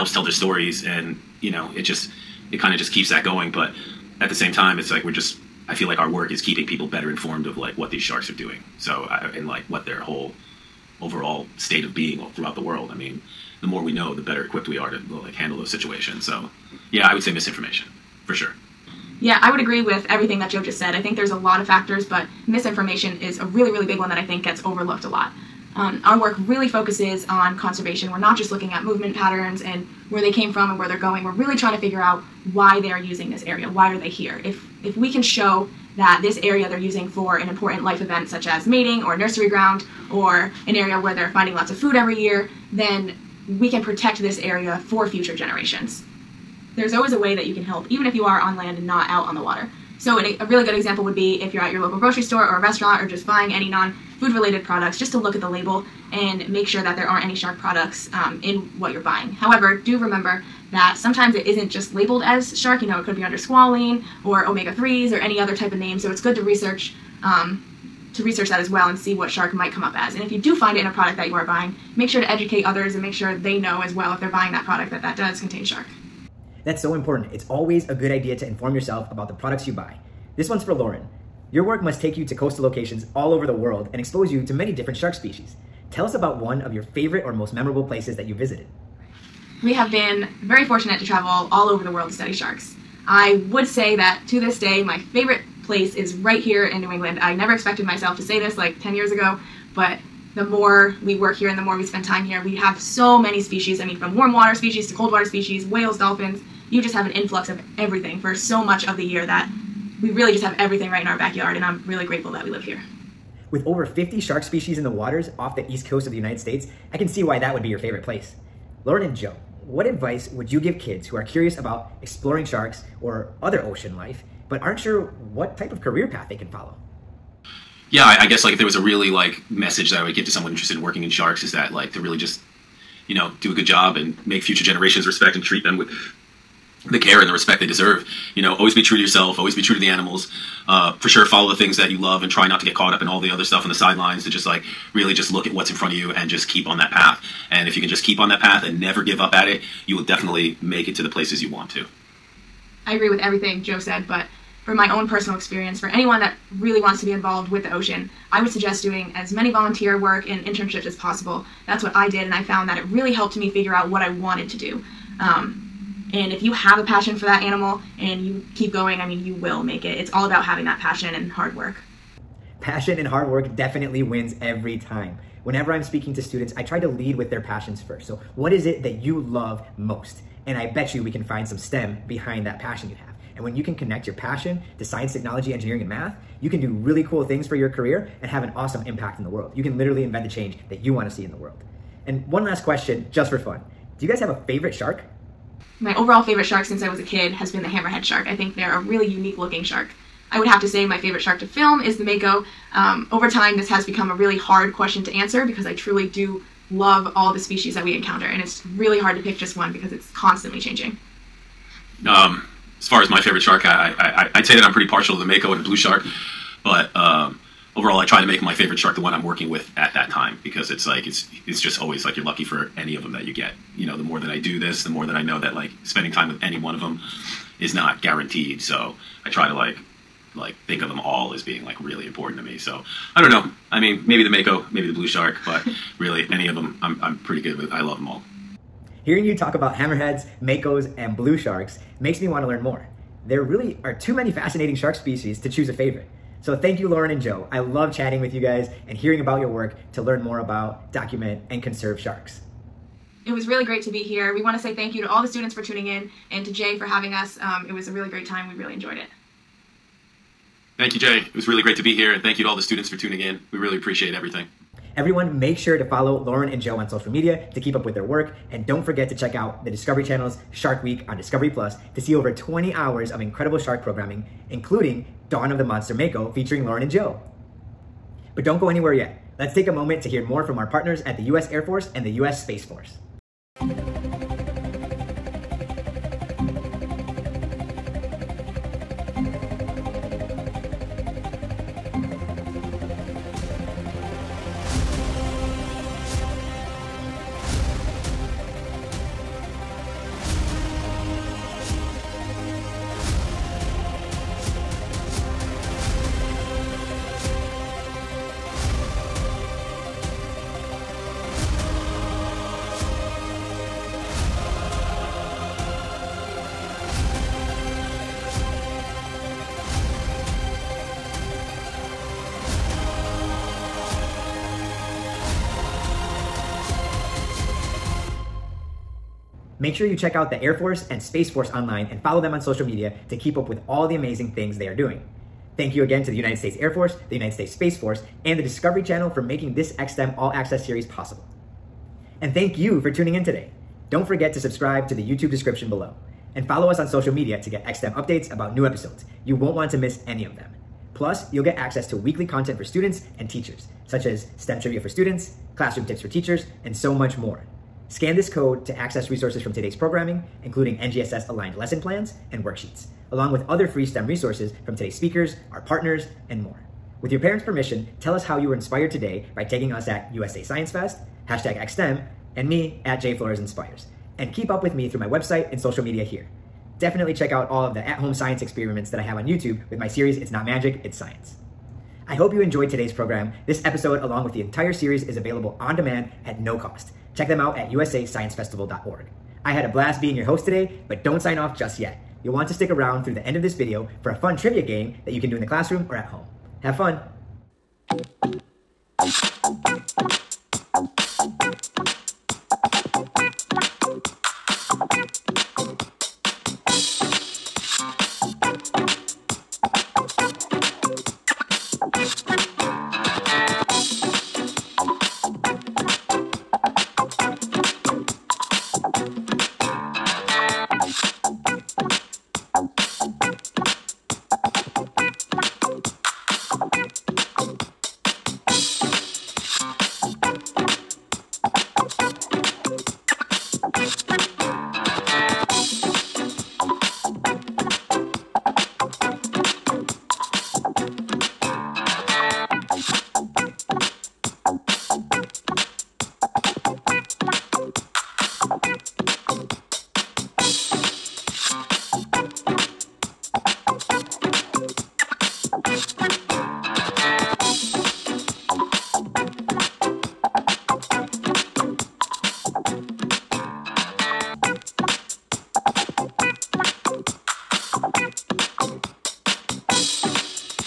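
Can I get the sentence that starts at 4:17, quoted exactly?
Um, it was a really great time.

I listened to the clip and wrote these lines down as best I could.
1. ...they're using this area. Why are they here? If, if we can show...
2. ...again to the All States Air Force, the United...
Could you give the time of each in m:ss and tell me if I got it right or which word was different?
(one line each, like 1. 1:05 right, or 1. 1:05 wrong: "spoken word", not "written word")
1. 0:32 right
2. 5:35 wrong: "United", not "All".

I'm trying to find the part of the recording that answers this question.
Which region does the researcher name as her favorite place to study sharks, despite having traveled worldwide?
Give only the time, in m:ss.
1:36.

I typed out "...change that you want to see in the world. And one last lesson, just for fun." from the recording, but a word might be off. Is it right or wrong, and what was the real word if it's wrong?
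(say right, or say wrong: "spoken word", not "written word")
wrong: "question", not "lesson".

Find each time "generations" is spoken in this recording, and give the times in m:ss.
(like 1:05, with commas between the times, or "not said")
0:45, 2:14.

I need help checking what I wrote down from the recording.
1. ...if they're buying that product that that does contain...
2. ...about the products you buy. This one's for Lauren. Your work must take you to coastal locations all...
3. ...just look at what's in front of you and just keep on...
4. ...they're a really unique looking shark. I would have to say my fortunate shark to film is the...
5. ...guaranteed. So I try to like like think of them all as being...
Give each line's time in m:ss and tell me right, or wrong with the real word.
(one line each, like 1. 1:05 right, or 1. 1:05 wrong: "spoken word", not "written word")
1. 1:14 right
2. 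1:19 right
3. 2:25 right
4. 3:18 wrong: "favorite", not "fortunate"
5. 3:48 right.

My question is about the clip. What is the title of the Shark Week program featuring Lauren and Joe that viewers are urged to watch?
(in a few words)
Dawn of the Monster Mako.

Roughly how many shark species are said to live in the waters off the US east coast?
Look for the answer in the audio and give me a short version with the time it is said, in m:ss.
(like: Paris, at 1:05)
over 50, at 1:53.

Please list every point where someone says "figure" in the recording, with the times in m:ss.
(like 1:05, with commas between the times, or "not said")
0:31, 2:43.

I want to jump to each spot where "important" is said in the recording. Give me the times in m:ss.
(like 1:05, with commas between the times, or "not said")
0:37, 1:16, 3:52.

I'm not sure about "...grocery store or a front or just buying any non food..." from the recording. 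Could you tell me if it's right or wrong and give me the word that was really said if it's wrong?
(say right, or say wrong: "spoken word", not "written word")
wrong: "restaurant", not "front".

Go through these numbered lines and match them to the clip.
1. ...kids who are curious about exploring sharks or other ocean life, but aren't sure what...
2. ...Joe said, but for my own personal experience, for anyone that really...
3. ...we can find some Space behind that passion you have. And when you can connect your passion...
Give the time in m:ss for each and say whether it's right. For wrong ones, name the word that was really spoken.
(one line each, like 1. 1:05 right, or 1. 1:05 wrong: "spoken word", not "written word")
1. 2:00 right
2. 2:33 right
3. 3:01 wrong: "STEM", not "Space".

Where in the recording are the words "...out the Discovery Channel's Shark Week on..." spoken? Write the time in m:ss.
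4:29.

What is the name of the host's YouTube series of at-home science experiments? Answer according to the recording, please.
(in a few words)
It's Not Magic, It's Science.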